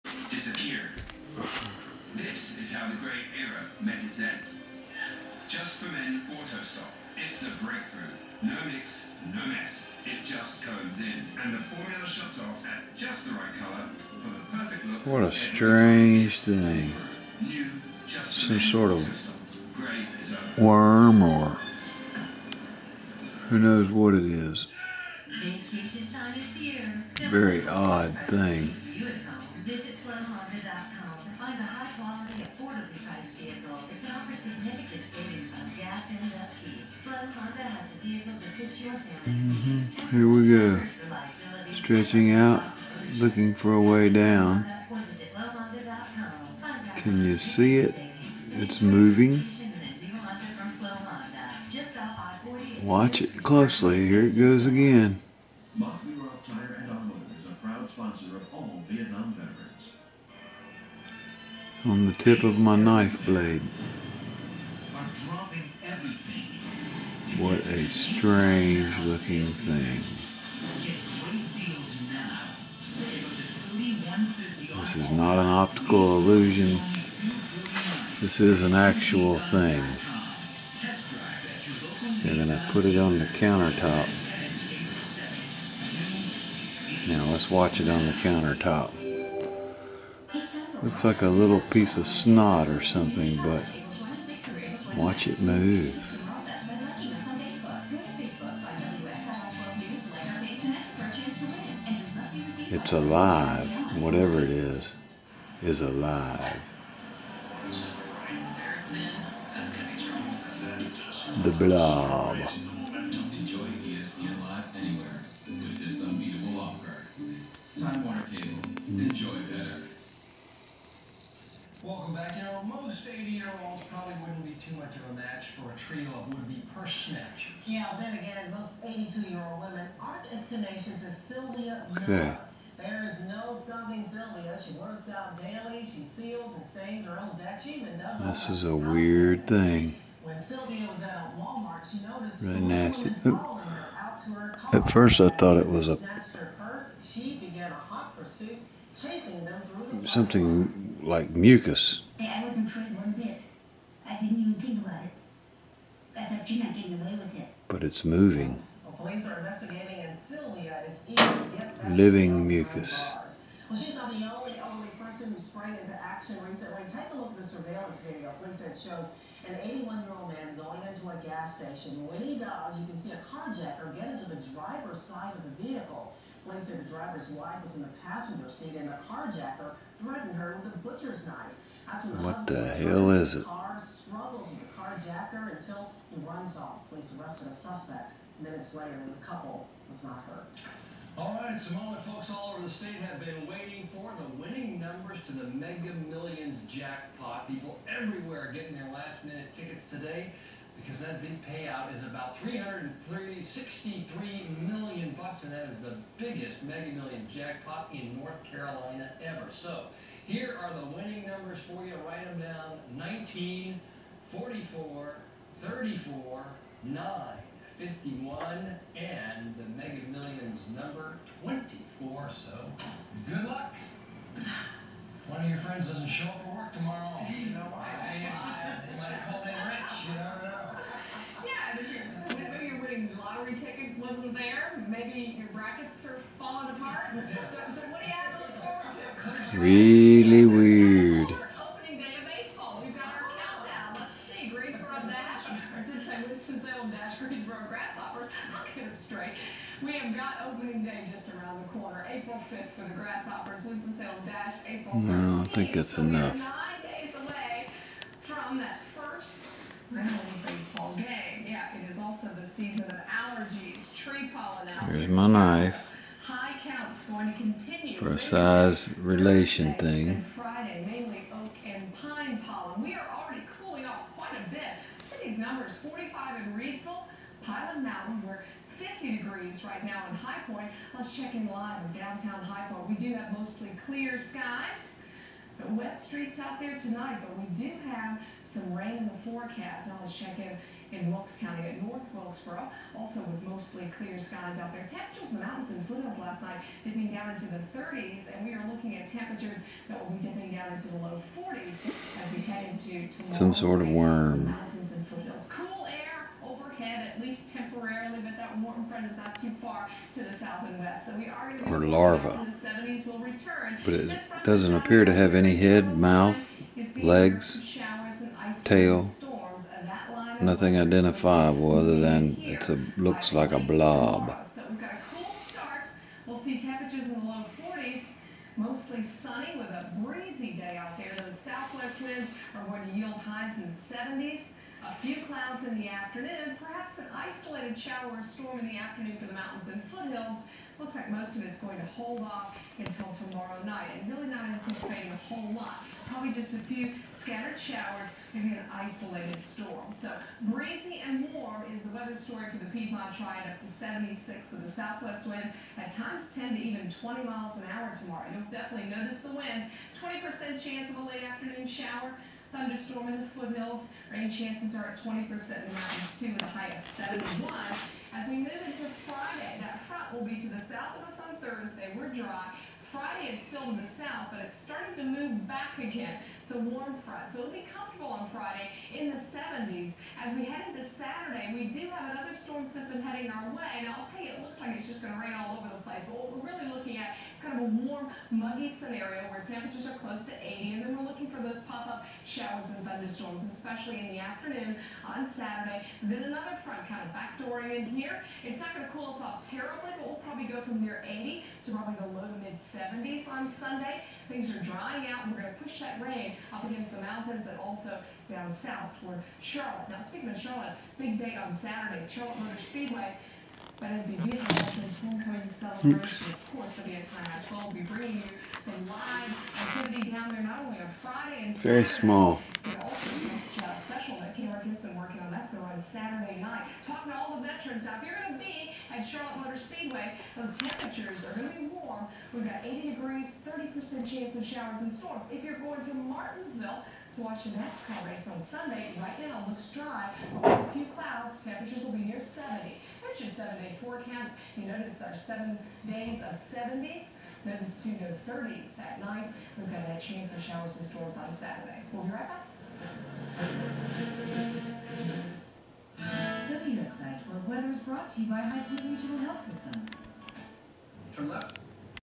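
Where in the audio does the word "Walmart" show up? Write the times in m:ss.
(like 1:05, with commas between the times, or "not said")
2:21.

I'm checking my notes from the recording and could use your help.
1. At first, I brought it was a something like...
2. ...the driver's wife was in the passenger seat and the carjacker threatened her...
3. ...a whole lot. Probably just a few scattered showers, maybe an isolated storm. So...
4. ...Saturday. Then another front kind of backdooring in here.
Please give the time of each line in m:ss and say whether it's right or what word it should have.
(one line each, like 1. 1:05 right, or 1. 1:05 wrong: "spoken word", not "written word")
1. 2:24 wrong: "thought", not "brought"
2. 2:56 right
3. 5:45 right
4. 6:35 right.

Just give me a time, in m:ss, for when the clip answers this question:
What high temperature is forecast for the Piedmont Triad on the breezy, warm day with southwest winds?
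5:53.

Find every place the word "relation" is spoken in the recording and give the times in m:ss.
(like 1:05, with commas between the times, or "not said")
4:28.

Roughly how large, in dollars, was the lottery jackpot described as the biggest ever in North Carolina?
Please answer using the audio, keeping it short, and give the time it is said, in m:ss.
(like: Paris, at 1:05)
$363 million, at 3:22.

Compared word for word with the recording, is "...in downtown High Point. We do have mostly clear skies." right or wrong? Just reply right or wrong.
right.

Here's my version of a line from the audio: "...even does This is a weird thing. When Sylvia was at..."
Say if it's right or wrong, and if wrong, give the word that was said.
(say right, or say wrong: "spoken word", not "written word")
right.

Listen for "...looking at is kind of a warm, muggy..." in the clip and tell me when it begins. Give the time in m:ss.
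6:26.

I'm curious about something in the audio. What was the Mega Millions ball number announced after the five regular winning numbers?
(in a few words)
24.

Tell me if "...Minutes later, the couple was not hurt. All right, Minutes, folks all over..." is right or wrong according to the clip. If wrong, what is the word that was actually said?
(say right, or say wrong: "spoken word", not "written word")
wrong: "Simone", not "Minutes".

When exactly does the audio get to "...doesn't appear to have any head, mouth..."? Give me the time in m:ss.
5:14.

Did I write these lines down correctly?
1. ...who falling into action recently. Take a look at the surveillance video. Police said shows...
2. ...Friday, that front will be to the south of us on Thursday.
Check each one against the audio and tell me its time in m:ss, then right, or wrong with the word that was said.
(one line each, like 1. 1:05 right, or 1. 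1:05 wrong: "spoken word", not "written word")
1. 2:45 wrong: "sprang", not "falling"
2. 6:09 right.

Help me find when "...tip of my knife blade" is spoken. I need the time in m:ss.
1:02.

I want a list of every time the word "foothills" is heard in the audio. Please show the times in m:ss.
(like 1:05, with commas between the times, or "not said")
4:55, 5:39, 6:03.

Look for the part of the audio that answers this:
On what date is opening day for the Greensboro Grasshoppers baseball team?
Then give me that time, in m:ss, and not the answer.
4:12.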